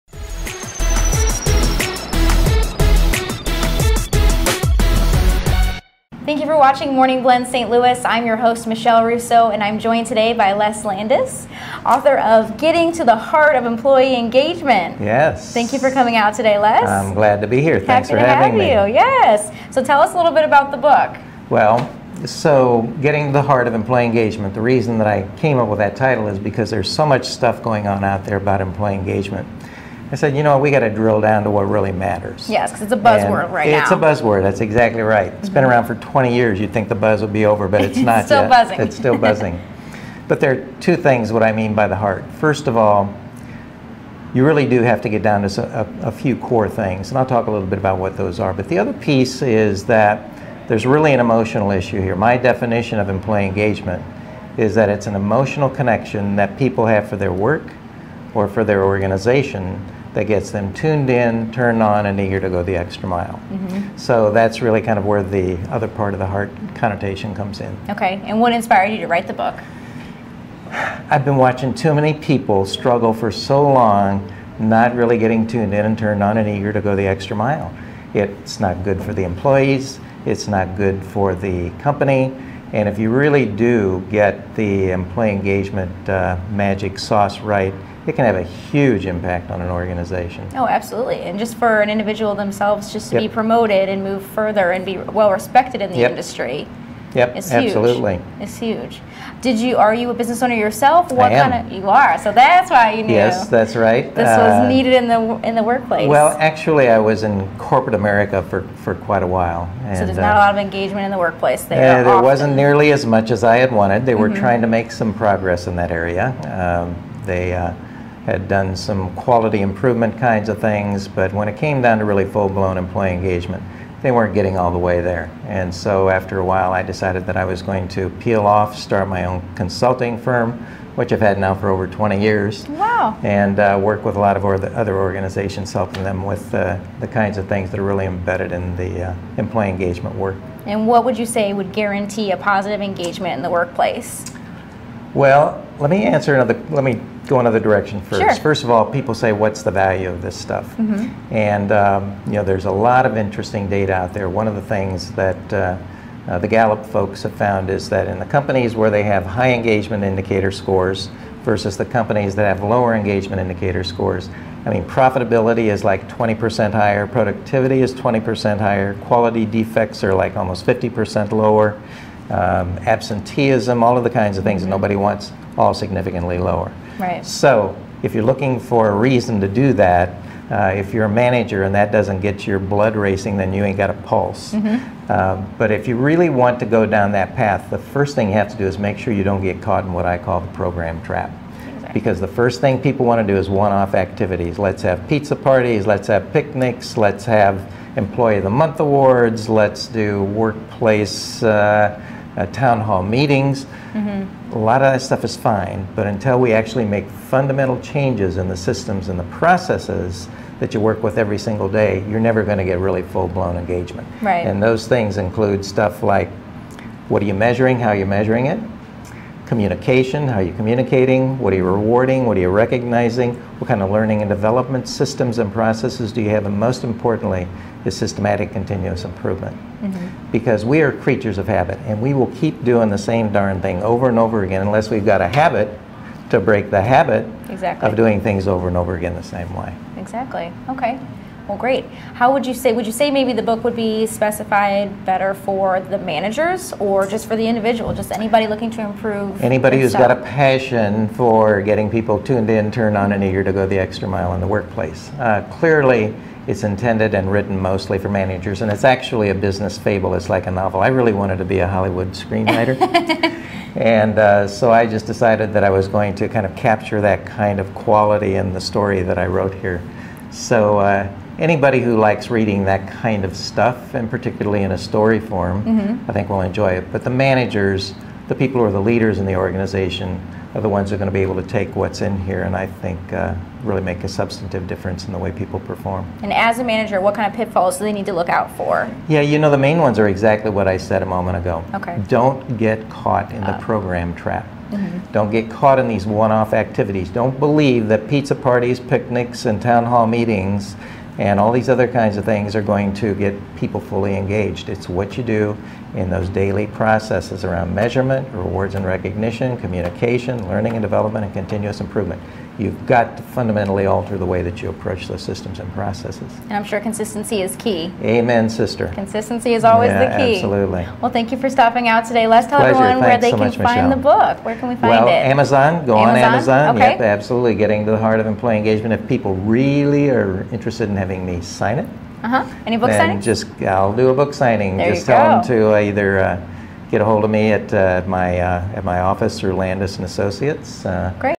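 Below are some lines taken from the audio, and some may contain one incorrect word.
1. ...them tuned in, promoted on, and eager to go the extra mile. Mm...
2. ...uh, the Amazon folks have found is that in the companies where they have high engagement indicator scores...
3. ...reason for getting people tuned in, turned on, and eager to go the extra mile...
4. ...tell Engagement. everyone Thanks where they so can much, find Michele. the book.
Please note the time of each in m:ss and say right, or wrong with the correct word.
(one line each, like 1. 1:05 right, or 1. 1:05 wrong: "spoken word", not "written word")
1. 1:00 wrong: "turned", not "promoted"
2. 2:35 wrong: "Gallup", not "Amazon"
3. 4:10 wrong: "passion", not "reason"
4. 5:22 wrong: "Pleasure", not "Engagement".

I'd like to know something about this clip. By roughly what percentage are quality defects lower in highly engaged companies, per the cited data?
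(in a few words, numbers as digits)
Almost 50%.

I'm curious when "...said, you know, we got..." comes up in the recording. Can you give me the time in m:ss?
0:30.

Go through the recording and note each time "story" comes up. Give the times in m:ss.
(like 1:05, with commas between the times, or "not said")
4:28, 4:34.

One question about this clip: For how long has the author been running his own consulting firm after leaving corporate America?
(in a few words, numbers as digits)
Over 20 years.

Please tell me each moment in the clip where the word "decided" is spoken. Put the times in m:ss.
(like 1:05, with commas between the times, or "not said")
2:06, 4:25.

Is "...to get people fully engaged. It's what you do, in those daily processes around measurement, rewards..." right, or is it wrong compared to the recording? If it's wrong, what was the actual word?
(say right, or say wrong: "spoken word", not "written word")
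right.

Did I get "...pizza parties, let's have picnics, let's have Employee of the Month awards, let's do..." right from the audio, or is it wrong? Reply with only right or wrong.
right.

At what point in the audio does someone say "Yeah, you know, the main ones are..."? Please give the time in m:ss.
4:49.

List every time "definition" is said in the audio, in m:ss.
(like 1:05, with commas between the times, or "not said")
0:52.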